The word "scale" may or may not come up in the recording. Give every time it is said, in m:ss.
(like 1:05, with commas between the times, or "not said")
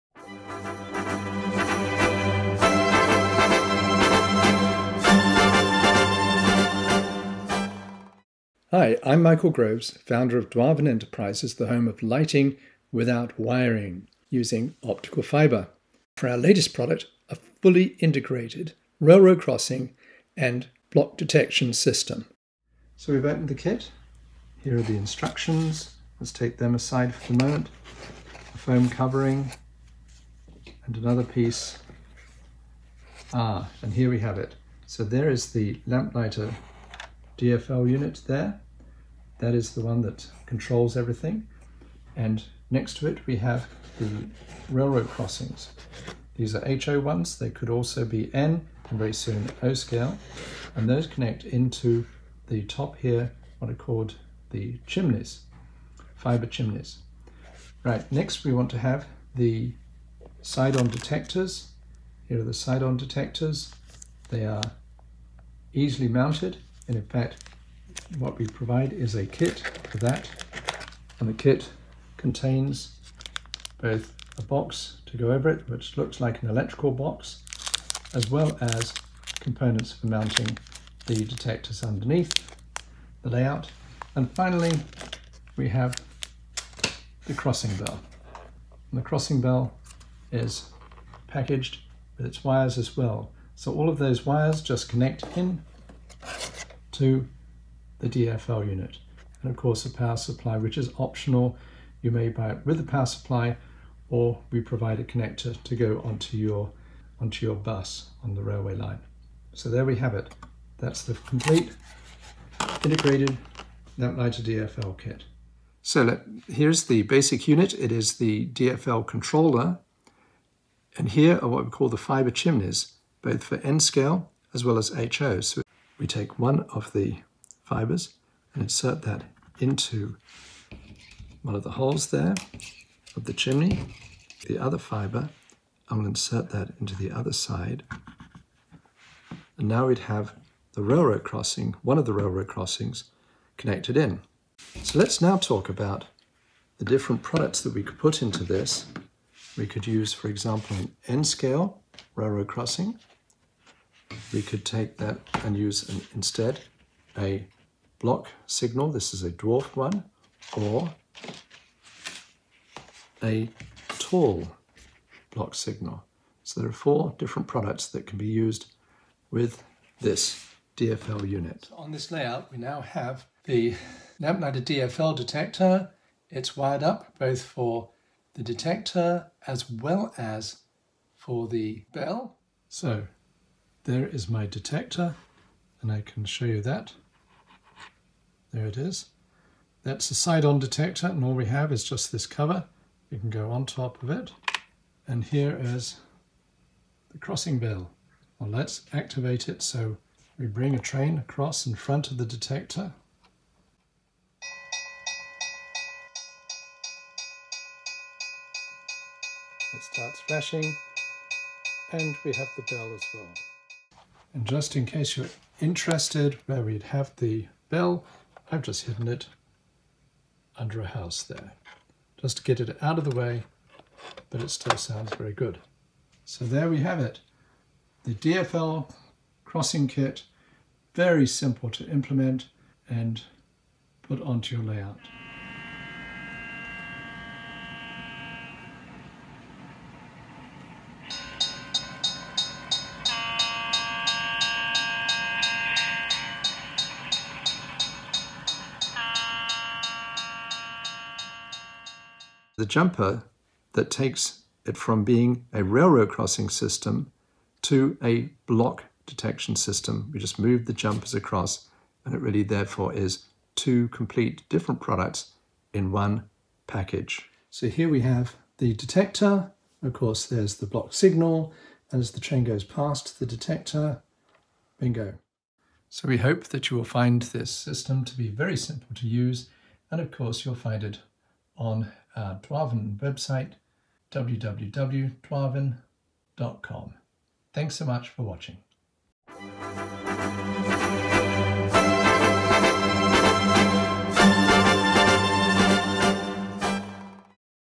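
0:49, 2:03, 2:31.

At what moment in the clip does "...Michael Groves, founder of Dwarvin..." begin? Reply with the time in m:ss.
0:09.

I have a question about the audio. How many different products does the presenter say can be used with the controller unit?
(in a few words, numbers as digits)
4.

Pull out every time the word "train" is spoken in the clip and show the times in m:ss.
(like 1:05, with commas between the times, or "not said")
3:20, 4:32.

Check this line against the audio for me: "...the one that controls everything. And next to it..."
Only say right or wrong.
right.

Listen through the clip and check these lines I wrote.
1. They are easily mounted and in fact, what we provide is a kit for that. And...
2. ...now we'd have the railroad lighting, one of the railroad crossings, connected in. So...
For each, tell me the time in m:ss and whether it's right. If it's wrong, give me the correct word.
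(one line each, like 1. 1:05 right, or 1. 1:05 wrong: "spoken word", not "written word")
1. 1:04 right
2. 2:19 wrong: "crossing", not "lighting".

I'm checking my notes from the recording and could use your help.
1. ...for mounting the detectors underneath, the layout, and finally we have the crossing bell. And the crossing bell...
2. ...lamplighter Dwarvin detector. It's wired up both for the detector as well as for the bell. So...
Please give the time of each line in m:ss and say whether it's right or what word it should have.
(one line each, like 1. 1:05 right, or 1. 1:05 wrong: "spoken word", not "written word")
1. 1:19 right
2. 2:54 wrong: "DFL", not "Dwarvin".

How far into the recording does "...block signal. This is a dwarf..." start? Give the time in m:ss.
2:37.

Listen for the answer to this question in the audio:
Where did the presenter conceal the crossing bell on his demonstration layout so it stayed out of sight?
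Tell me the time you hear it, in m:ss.
3:40.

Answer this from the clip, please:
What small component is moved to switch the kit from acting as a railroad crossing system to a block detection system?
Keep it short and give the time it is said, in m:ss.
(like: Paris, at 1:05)
The jumpers, at 4:20.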